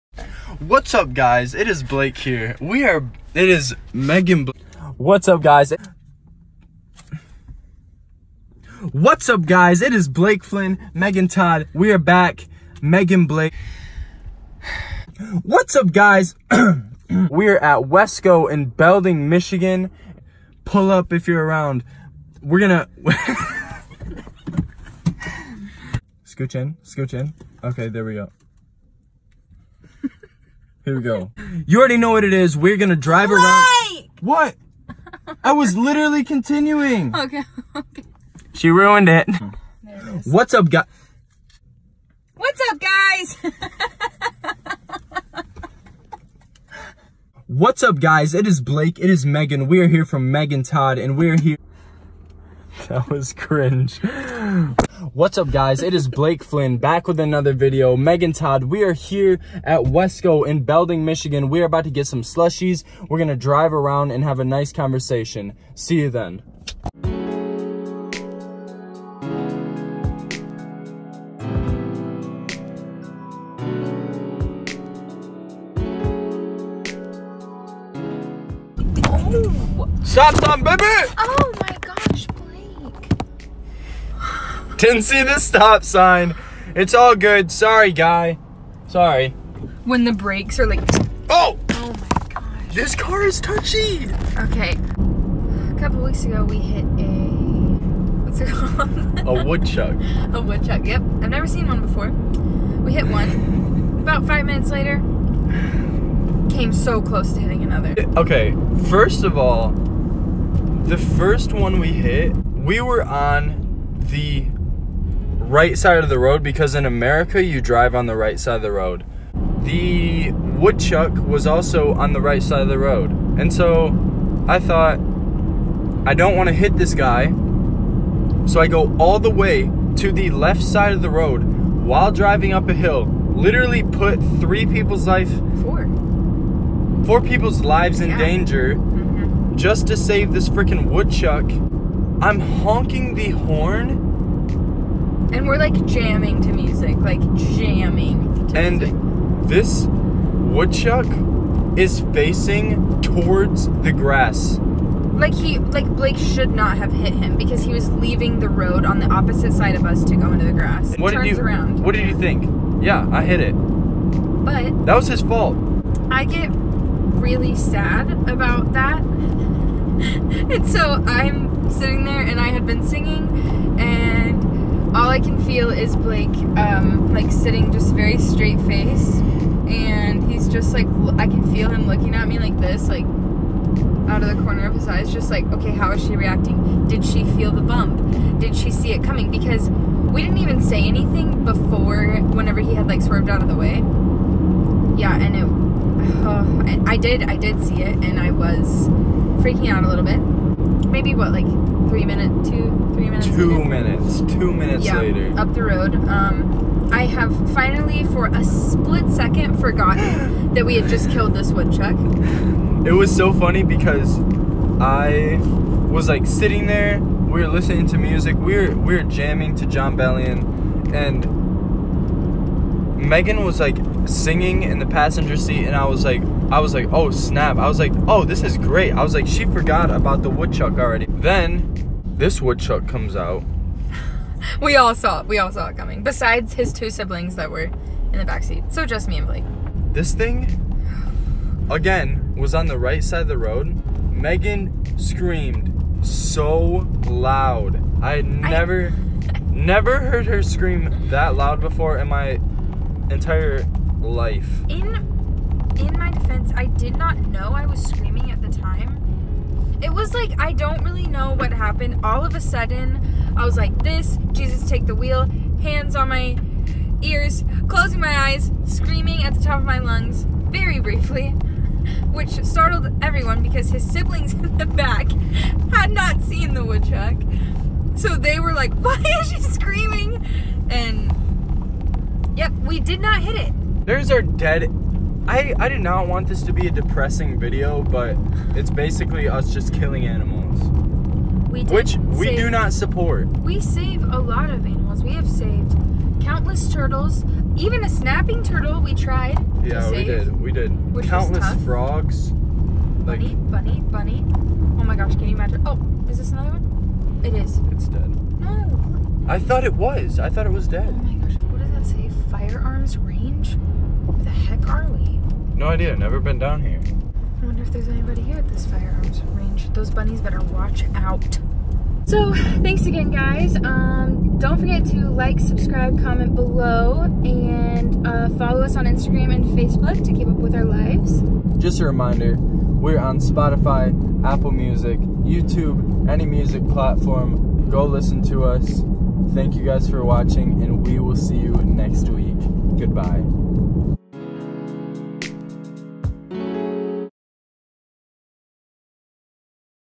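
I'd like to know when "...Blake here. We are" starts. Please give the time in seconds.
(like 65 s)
1 s.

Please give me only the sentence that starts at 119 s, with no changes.
The woodchuck was also on the right side of the road.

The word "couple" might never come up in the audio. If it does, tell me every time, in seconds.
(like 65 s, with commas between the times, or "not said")
95 s.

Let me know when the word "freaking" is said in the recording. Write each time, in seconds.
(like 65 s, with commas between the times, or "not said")
140 s, 199 s.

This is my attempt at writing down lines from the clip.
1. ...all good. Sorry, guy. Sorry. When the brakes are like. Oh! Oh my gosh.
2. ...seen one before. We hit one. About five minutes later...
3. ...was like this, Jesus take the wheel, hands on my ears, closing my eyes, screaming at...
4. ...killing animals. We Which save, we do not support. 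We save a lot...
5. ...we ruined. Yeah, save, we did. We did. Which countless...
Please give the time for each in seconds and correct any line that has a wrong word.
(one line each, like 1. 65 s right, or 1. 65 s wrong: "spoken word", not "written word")
1. 86 s right
2. 101 s right
3. 263 s right
4. 289 s right
5. 298 s wrong: "tried", not "ruined".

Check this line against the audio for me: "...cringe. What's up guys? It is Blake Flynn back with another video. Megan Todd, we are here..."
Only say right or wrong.
right.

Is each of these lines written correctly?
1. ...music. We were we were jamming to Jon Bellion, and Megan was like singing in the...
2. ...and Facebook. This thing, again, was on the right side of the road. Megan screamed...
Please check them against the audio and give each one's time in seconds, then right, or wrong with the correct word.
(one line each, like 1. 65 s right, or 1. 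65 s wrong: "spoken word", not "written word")
1. 217 s right
2. 239 s wrong: "Blake", not "Facebook".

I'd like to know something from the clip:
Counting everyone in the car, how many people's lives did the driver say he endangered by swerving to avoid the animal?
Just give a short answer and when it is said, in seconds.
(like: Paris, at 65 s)
4, at 137 s.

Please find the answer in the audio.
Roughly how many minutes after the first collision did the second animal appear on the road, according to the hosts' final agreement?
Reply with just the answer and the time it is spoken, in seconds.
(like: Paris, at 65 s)
2, at 204 s.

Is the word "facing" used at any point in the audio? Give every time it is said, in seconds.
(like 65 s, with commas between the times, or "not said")
152 s.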